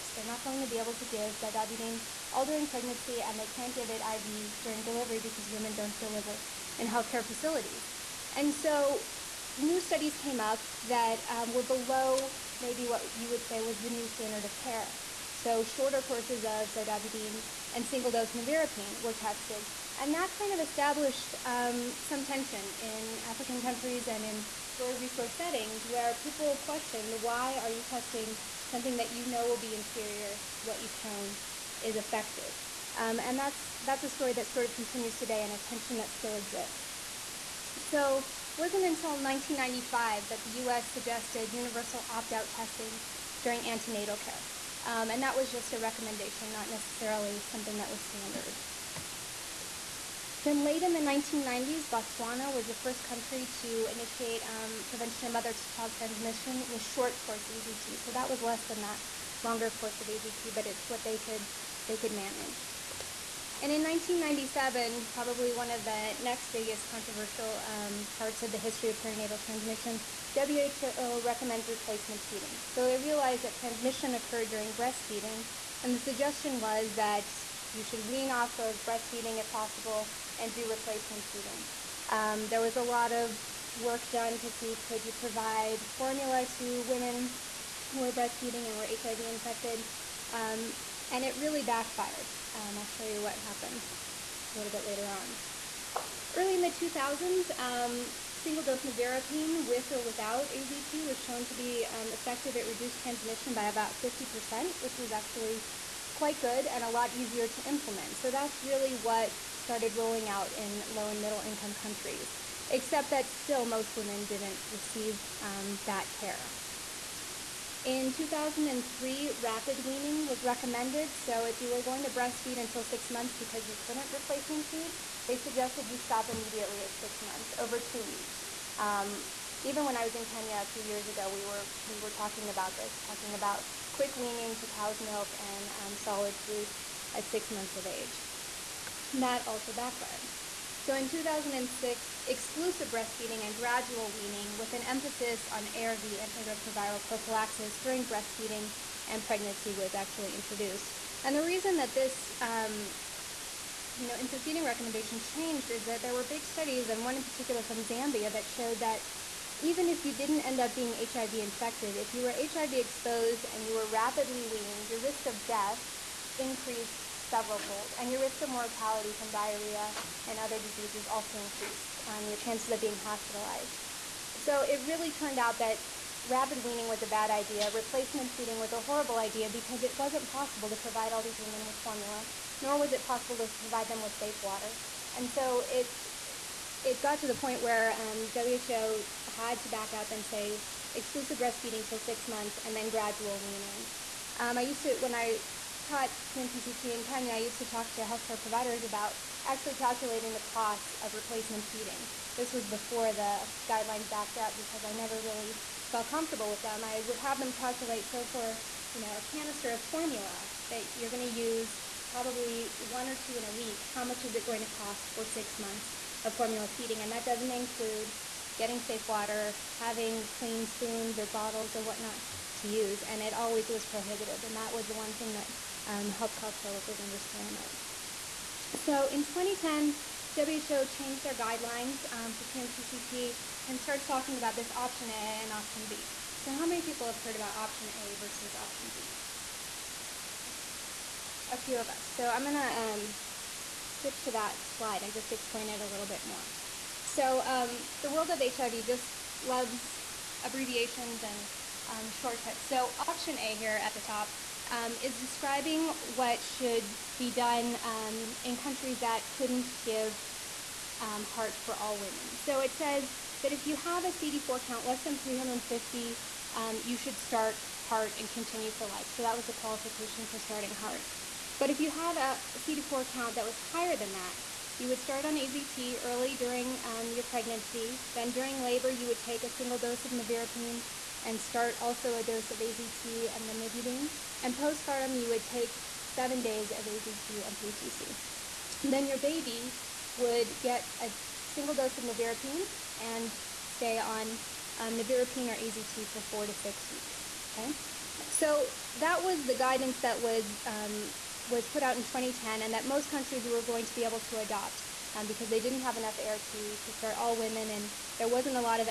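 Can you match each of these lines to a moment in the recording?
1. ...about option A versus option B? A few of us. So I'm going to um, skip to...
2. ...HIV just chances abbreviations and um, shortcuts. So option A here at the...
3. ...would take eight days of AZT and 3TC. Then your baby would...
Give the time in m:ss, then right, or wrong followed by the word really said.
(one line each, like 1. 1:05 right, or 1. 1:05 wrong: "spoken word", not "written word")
1. 3:57 right
2. 4:08 wrong: "loves", not "chances"
3. 4:45 wrong: "seven", not "eight".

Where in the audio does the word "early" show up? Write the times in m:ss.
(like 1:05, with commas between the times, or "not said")
1:36, 4:36.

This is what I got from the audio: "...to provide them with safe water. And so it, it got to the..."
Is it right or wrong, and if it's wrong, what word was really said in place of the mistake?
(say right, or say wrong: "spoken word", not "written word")
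right.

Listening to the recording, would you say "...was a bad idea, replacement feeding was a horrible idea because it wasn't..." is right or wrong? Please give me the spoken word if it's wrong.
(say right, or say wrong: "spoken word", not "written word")
right.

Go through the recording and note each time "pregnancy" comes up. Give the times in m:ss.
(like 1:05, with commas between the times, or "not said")
0:02, 2:29, 4:37.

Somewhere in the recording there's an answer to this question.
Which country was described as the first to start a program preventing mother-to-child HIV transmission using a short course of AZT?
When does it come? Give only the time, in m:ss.
0:51.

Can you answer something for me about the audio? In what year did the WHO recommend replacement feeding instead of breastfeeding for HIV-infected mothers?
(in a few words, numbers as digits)
1997.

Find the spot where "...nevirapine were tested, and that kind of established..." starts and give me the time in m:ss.
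0:18.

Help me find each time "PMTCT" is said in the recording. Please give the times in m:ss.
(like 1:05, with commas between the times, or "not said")
3:16, 3:52.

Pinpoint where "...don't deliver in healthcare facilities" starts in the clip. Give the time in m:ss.
0:05.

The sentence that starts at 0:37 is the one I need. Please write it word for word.
So it wasn't until 1995 that the U.S.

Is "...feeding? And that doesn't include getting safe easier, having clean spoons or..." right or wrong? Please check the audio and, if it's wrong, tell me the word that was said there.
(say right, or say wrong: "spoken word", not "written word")
wrong: "water", not "easier".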